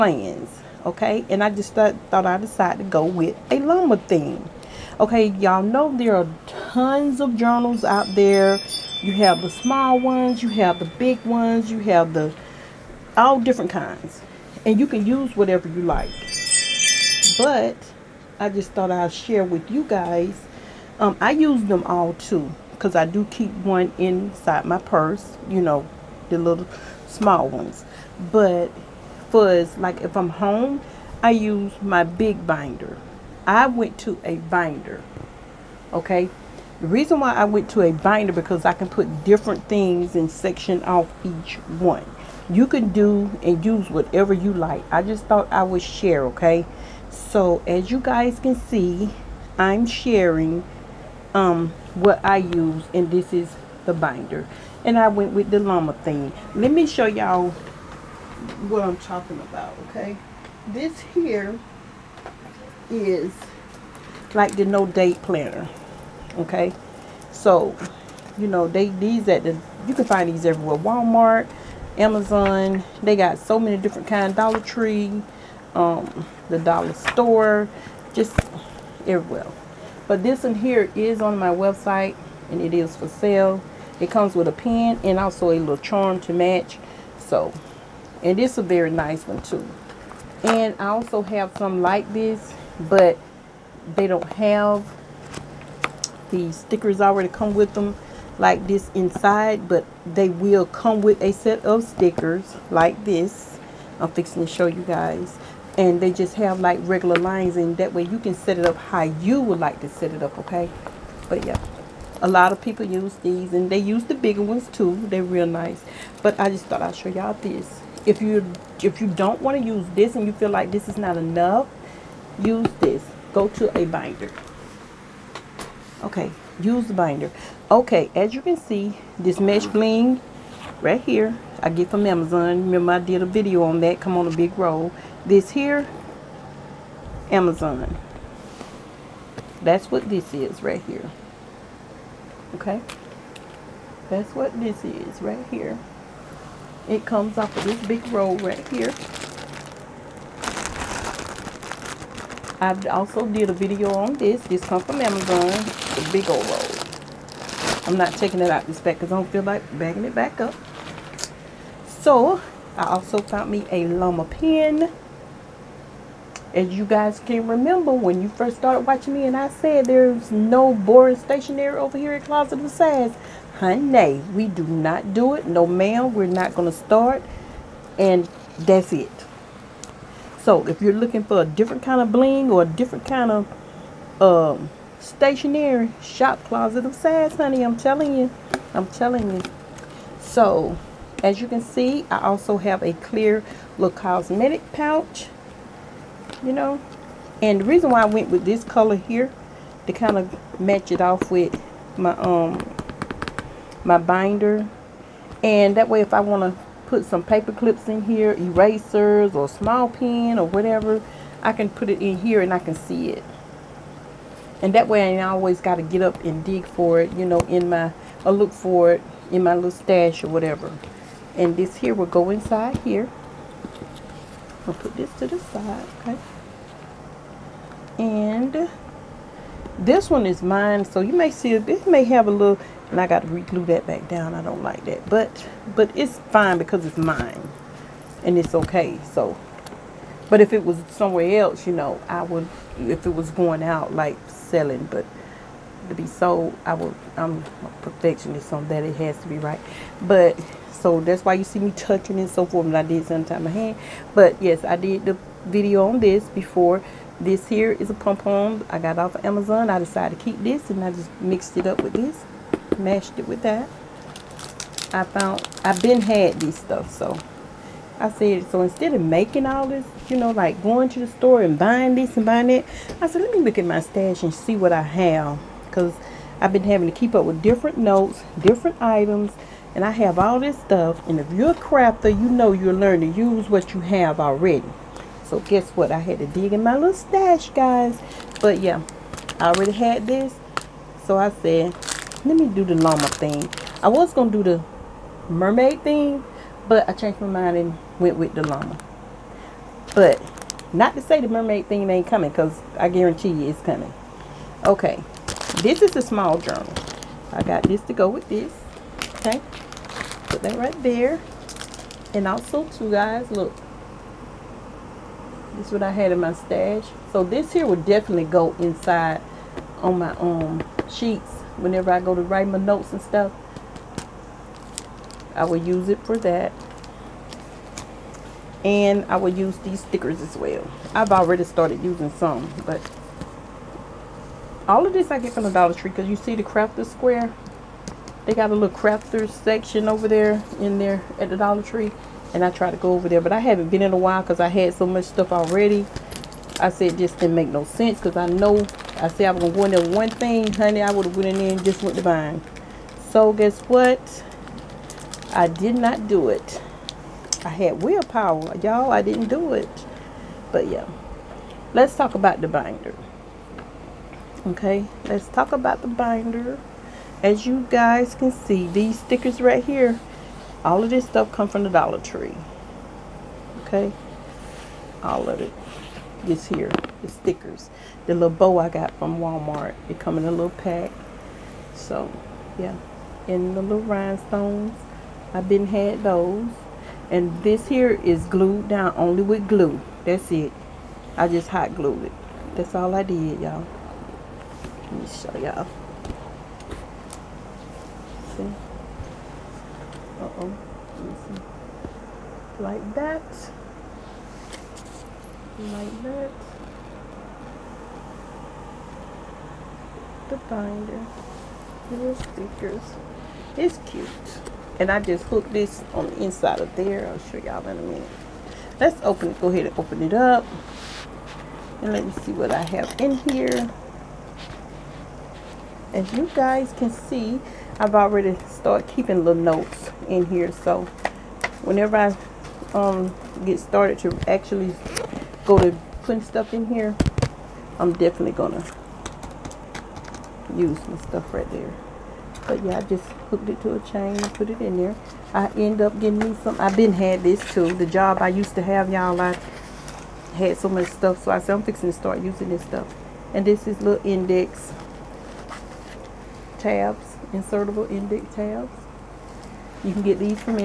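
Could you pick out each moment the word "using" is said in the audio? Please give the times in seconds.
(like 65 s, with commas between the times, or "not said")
331 s, 452 s.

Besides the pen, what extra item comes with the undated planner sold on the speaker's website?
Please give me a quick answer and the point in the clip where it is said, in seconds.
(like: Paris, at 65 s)
a little charm, at 85 s.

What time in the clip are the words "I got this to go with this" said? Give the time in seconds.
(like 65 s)
307 s.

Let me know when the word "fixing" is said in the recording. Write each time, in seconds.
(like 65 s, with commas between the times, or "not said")
104 s, 451 s.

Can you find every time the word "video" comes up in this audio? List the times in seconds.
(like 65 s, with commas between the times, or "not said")
133 s, 153 s, 255 s.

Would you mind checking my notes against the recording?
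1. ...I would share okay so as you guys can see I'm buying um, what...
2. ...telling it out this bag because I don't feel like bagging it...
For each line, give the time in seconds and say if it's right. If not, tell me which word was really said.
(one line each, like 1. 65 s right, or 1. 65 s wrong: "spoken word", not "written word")
1. 45 s wrong: "sharing", not "buying"
2. 158 s wrong: "taking", not "telling".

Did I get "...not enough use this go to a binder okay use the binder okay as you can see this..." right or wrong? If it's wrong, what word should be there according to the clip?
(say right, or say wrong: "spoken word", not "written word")
right.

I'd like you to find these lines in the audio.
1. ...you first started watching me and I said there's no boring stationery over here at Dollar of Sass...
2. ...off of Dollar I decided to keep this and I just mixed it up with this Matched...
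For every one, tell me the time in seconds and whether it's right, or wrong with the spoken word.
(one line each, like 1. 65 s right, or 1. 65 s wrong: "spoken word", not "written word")
1. 168 s wrong: "Closet", not "Dollar"
2. 258 s wrong: "Amazon", not "Dollar".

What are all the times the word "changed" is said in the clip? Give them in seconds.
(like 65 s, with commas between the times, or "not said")
296 s.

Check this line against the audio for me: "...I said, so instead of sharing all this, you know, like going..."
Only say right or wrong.
wrong.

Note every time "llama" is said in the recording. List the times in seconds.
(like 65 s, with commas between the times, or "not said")
3 s, 55 s, 163 s, 292 s, 298 s.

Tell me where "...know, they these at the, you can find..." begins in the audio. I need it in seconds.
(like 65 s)
68 s.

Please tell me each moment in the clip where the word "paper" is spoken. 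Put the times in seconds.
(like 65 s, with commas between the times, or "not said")
207 s.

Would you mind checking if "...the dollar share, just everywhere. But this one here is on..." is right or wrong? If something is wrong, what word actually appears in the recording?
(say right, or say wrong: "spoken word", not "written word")
wrong: "store", not "share".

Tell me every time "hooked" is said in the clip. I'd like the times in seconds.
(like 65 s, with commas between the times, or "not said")
415 s, 443 s.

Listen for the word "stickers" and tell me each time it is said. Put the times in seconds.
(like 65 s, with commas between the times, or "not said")
96 s, 101 s, 329 s, 368 s, 377 s, 412 s.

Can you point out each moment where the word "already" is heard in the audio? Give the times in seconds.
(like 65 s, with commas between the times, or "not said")
97 s, 284 s, 289 s, 331 s, 345 s, 427 s.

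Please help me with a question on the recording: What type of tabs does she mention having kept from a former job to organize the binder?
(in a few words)
insertable index tabs.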